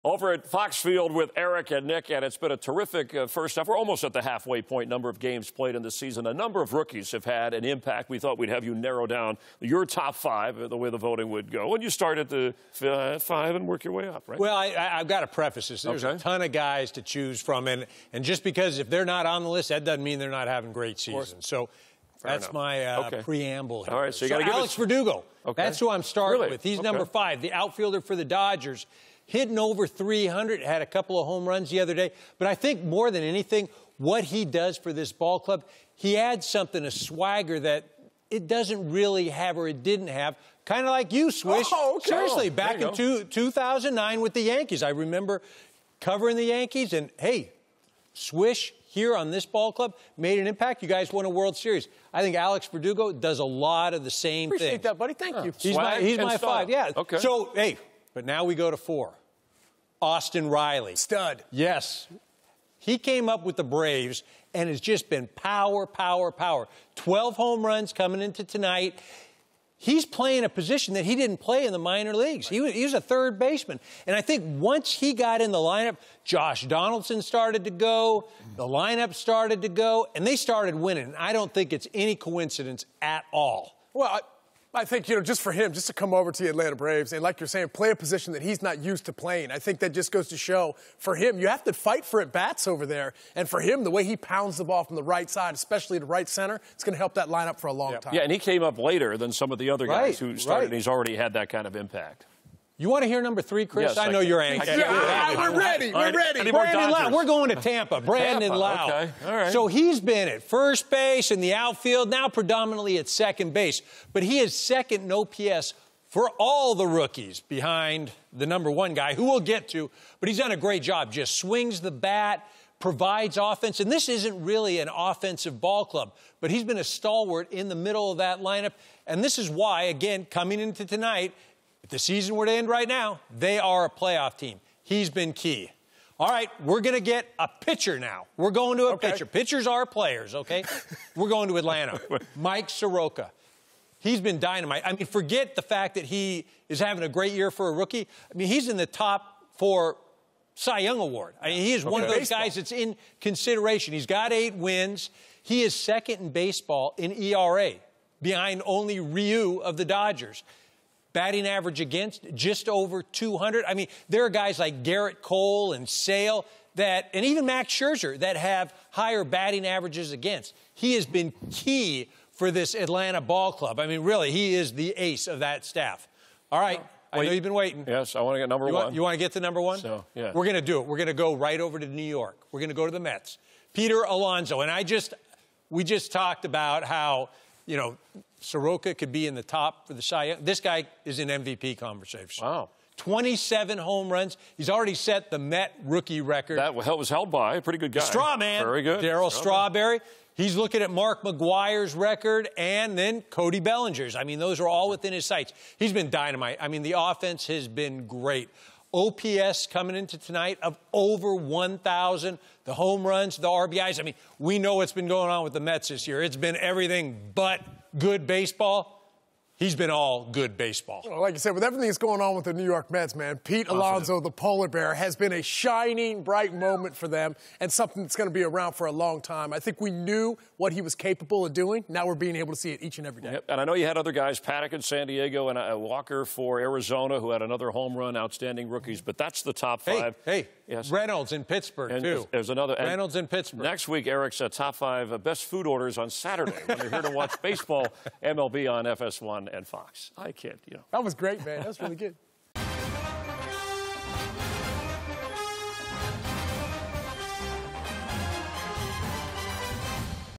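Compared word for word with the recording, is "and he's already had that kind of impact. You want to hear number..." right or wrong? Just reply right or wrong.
right.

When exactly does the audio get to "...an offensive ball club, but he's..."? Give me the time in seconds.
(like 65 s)
124 s.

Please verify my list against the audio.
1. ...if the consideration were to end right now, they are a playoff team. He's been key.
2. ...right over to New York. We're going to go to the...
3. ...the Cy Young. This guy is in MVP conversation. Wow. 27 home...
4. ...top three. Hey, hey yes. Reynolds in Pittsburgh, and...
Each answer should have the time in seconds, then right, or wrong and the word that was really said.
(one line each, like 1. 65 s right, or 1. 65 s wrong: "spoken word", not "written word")
1. 131 s wrong: "season", not "consideration"
2. 181 s right
3. 189 s right
4. 239 s wrong: "five", not "three".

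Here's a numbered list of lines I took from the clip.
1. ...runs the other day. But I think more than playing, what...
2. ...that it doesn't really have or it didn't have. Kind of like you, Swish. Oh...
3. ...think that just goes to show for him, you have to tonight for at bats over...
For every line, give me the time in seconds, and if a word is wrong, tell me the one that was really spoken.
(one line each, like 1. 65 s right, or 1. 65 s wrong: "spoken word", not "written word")
1. 31 s wrong: "anything", not "playing"
2. 37 s right
3. 89 s wrong: "fight", not "tonight".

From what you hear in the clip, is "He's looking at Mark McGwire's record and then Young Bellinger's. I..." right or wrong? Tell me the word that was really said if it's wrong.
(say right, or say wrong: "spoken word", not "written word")
wrong: "Cody", not "Young".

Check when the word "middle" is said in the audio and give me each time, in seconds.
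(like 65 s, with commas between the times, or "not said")
127 s.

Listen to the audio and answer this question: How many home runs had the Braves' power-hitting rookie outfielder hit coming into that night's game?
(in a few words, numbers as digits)
12.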